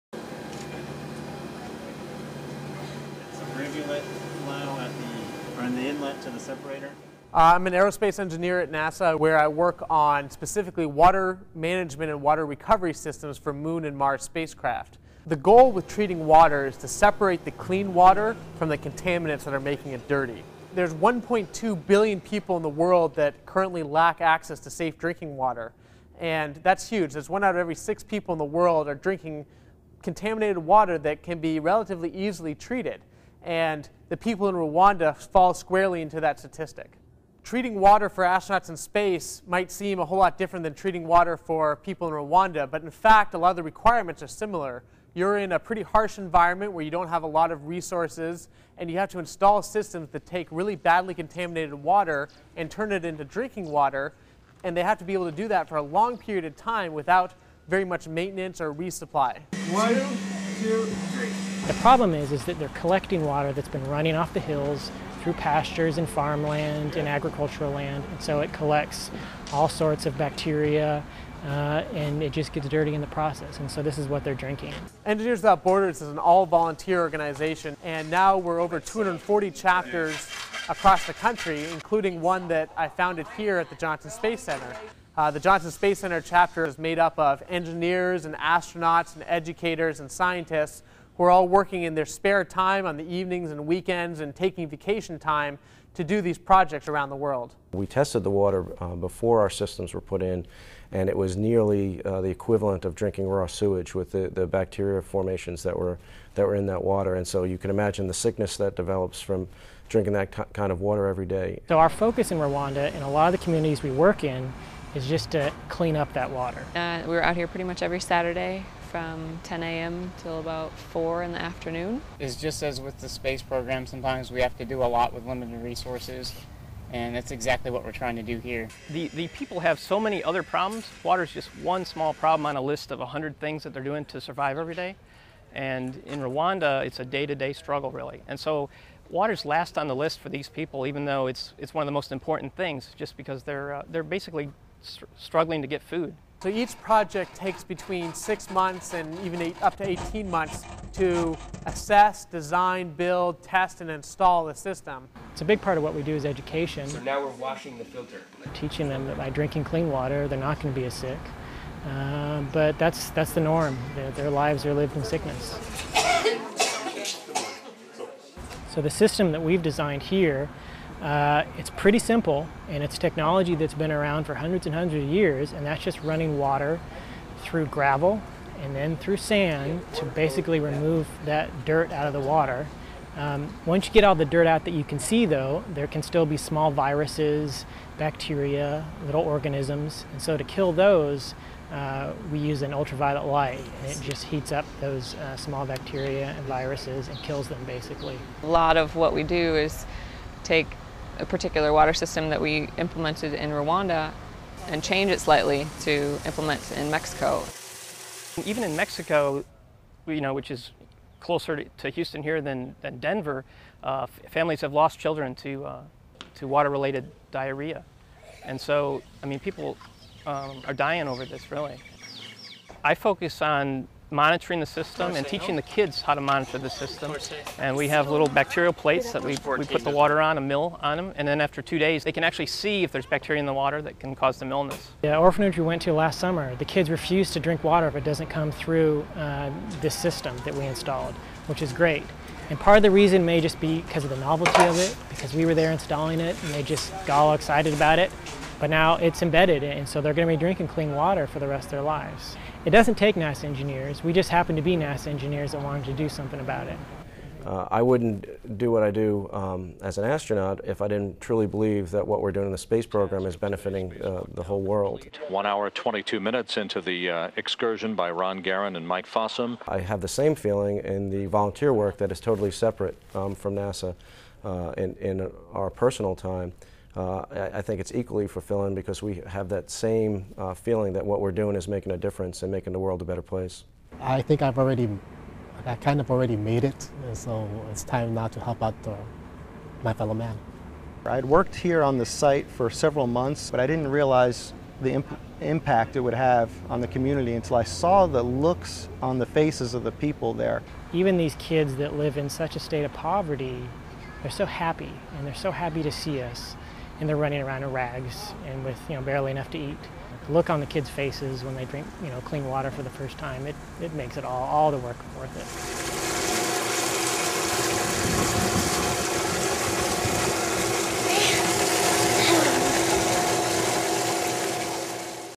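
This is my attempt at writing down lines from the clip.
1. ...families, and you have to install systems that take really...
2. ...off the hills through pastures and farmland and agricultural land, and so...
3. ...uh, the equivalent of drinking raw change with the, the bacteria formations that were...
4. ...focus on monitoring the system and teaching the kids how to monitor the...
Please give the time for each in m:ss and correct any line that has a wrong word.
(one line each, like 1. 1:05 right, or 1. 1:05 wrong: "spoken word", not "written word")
1. 0:47 wrong: "resources", not "families"
2. 1:04 right
3. 1:42 wrong: "sewage", not "change"
4. 3:42 right.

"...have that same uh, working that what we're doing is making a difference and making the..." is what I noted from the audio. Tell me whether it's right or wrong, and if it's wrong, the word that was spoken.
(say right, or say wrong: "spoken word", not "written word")
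wrong: "feeling", not "working".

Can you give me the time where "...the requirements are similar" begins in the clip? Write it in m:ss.
0:43.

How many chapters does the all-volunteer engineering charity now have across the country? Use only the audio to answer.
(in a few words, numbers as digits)
over 240.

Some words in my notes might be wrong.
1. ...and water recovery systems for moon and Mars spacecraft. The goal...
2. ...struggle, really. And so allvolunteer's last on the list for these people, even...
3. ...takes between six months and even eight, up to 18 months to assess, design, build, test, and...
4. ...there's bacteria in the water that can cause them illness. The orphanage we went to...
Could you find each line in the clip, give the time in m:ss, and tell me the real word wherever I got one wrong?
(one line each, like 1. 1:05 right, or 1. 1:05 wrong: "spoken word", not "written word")
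1. 0:12 right
2. 2:17 wrong: "water", not "allvolunteer"
3. 2:27 right
4. 3:52 right.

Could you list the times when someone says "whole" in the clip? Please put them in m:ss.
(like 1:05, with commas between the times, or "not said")
0:40, 4:24.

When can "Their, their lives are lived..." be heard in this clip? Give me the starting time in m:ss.
2:43.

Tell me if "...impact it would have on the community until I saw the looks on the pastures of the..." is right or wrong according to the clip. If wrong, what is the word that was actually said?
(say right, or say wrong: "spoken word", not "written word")
wrong: "faces", not "pastures".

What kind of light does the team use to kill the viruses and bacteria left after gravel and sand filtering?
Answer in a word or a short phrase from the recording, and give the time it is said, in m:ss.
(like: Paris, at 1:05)
ultraviolet light, at 3:12.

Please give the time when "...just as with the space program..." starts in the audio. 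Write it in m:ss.
2:02.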